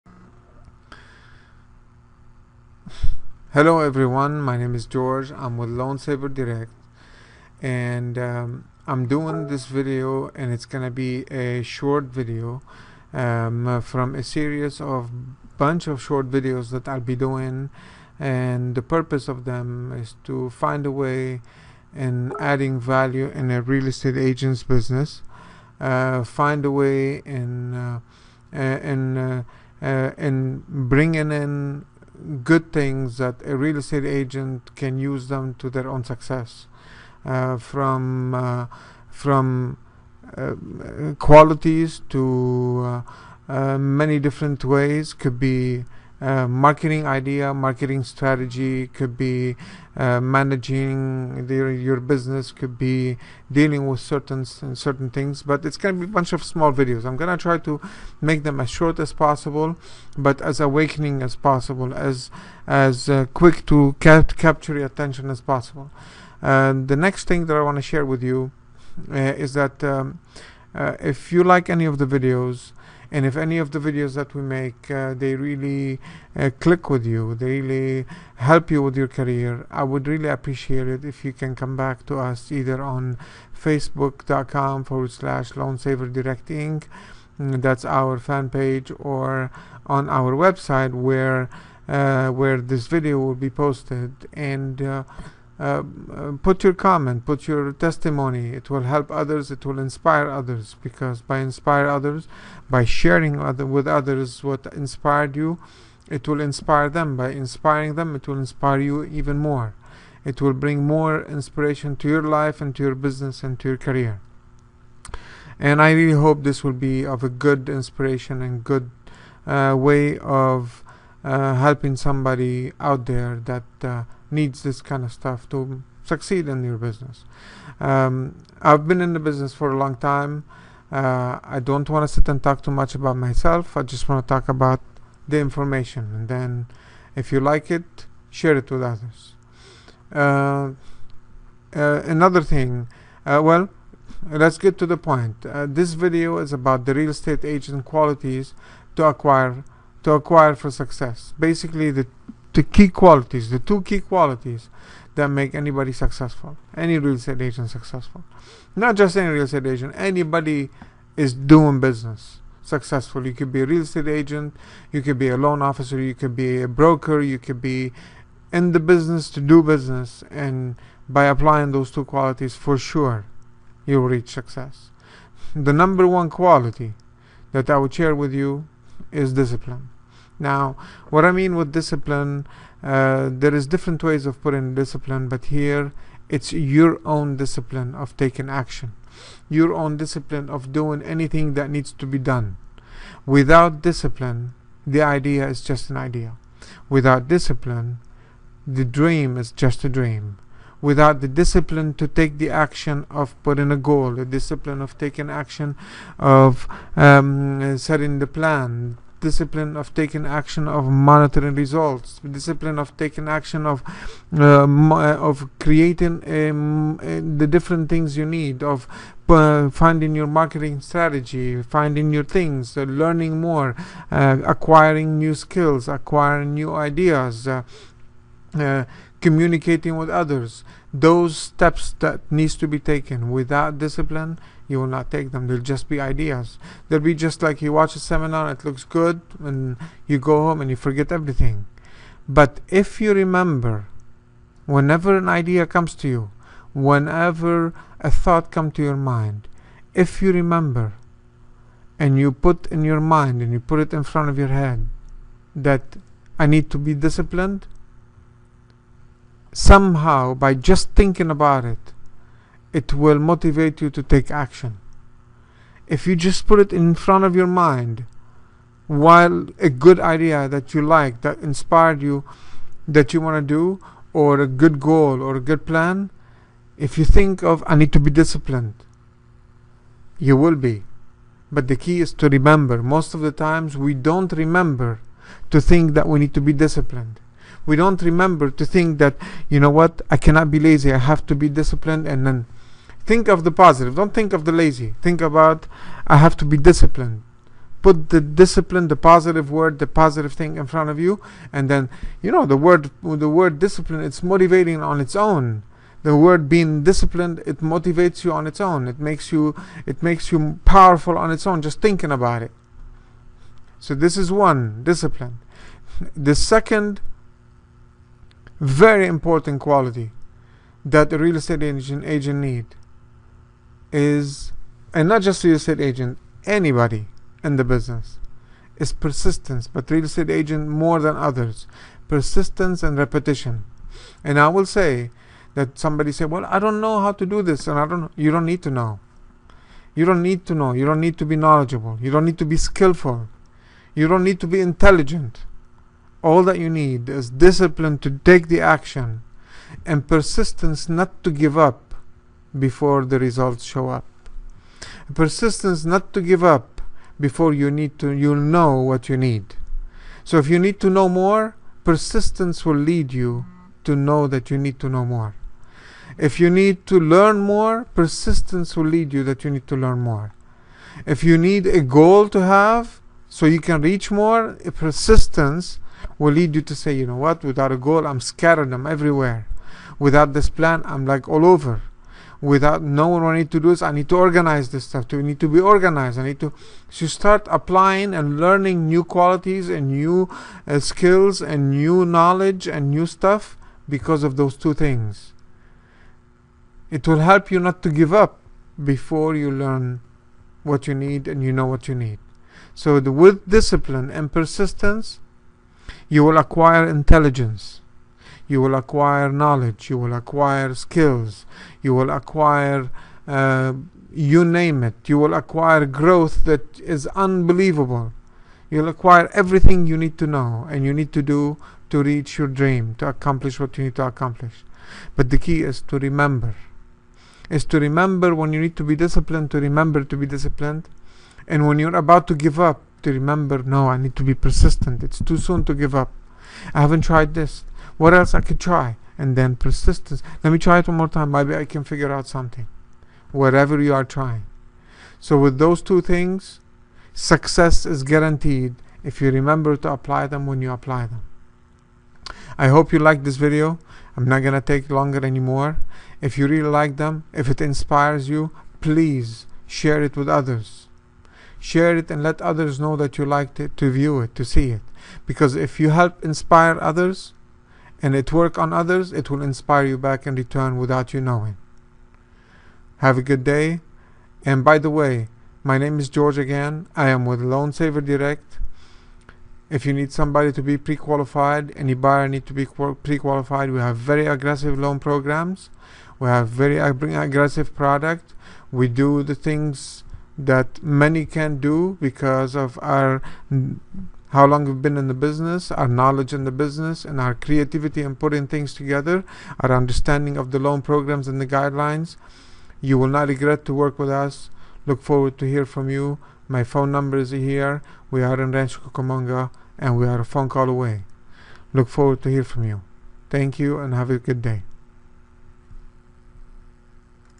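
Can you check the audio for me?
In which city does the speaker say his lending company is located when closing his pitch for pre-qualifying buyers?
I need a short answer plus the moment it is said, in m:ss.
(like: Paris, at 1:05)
Rancho Cucamonga, at 8:28.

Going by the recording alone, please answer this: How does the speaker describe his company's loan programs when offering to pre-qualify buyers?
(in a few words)
Very aggressive.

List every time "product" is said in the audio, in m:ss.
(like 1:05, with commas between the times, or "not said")
8:07.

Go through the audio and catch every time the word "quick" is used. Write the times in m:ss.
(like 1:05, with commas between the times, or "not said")
1:03.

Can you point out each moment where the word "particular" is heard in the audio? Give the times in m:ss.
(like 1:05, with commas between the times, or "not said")
not said.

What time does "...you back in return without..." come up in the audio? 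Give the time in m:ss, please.
7:49.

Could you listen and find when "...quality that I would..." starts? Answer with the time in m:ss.
2:56.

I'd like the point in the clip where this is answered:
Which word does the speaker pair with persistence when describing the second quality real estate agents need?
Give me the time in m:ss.
5:32.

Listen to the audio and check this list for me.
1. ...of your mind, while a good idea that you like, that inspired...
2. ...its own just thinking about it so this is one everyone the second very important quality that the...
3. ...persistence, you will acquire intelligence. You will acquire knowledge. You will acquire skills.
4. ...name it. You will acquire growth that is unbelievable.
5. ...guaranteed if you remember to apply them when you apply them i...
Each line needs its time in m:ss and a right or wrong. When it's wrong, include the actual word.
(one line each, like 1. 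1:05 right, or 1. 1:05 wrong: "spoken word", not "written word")
1. 4:27 right
2. 5:11 wrong: "discipline", not "everyone"
3. 6:44 right
4. 6:54 right
5. 7:28 right.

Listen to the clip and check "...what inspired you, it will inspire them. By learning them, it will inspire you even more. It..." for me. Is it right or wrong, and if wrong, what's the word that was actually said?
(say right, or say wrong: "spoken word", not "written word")
wrong: "inspiring", not "learning".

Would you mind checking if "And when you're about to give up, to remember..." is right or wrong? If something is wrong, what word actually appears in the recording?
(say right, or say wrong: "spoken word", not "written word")
right.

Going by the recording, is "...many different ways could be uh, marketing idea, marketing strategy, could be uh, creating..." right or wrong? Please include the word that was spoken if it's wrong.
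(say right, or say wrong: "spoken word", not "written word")
wrong: "managing", not "creating".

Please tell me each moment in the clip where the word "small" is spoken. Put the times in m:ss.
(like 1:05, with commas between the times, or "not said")
0:56.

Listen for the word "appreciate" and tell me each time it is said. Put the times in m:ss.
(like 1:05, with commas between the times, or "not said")
1:20.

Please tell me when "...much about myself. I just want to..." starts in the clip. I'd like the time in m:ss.
2:12.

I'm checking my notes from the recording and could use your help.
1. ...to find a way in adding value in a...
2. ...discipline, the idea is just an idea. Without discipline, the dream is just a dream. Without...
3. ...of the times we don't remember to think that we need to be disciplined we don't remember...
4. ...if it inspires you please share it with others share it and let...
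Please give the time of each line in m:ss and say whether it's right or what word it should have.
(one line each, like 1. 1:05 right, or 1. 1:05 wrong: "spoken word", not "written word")
1. 0:20 right
2. 3:13 right
3. 4:43 right
4. 7:37 right.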